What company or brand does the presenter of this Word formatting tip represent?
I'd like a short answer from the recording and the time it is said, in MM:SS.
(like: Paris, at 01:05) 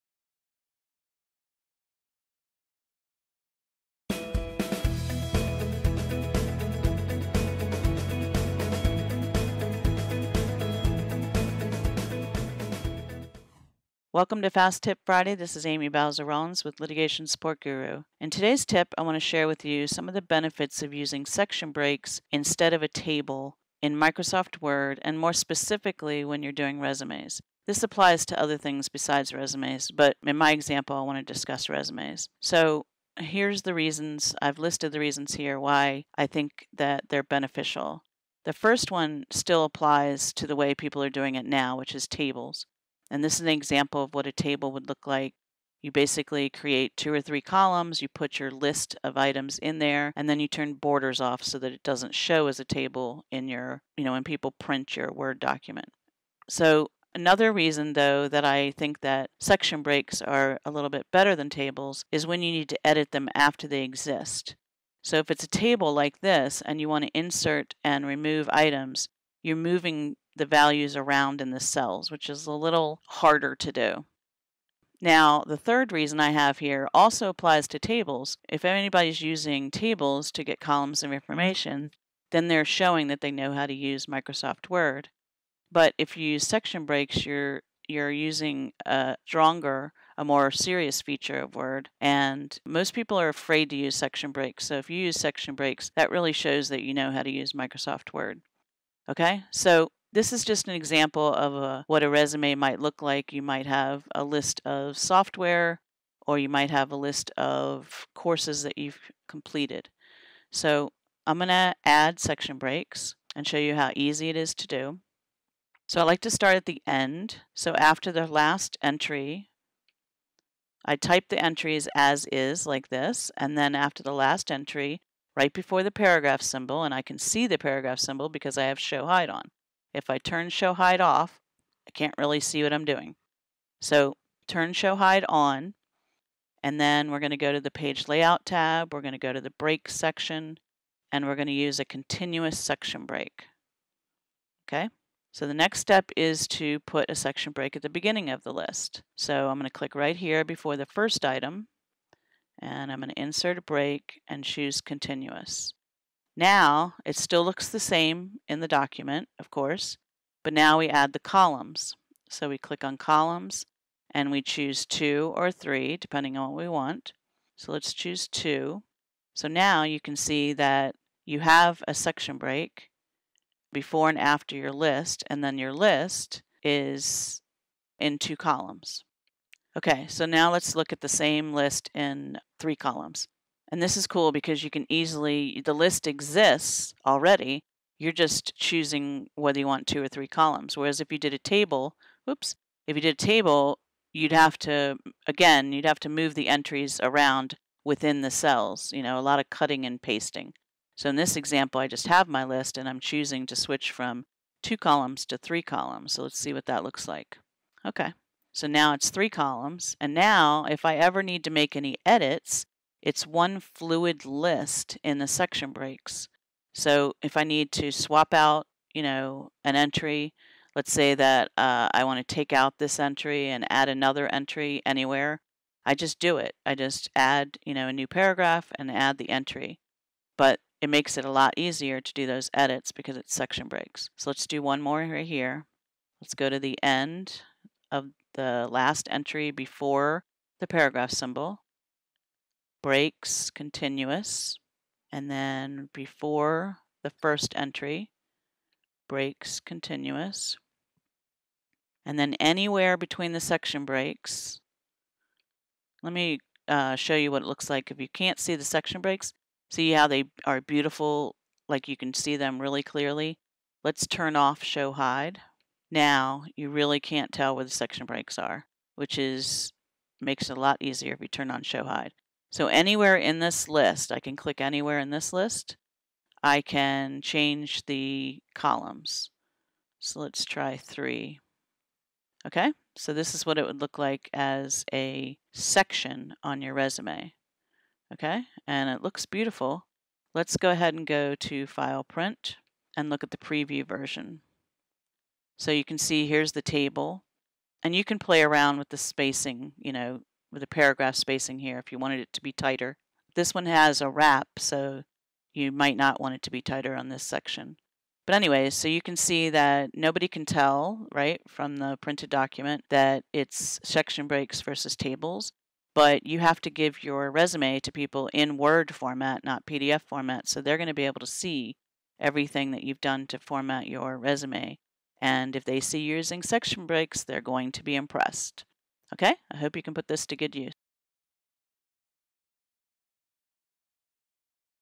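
Litigation Support Guru, at 00:16.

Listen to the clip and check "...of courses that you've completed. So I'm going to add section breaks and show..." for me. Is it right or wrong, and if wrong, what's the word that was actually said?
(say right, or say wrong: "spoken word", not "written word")
right.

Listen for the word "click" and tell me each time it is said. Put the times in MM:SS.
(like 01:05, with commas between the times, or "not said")
02:29, 02:42, 04:34.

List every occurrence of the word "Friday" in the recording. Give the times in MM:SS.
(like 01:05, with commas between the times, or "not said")
00:15.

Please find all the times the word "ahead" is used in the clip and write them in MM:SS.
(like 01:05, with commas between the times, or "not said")
04:50.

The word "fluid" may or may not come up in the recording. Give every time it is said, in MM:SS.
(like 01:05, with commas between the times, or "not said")
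03:33.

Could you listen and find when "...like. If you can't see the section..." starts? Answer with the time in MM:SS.
04:17.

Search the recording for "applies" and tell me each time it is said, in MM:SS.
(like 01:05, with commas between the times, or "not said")
00:27, 00:39, 01:17.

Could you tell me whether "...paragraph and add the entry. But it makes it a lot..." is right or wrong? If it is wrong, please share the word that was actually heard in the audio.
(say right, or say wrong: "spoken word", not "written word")
right.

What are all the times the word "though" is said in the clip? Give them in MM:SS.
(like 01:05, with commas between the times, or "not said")
00:57.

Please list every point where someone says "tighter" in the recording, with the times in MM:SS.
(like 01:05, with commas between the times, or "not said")
05:02, 05:06.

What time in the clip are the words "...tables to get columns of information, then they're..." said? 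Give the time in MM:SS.
01:19.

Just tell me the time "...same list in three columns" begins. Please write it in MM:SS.
03:01.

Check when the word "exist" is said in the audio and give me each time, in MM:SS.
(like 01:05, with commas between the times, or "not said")
01:03, 03:06.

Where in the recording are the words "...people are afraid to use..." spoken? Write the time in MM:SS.
01:32.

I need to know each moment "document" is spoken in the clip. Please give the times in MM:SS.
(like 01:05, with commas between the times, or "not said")
00:55, 02:38, 05:12.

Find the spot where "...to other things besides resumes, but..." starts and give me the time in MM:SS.
00:28.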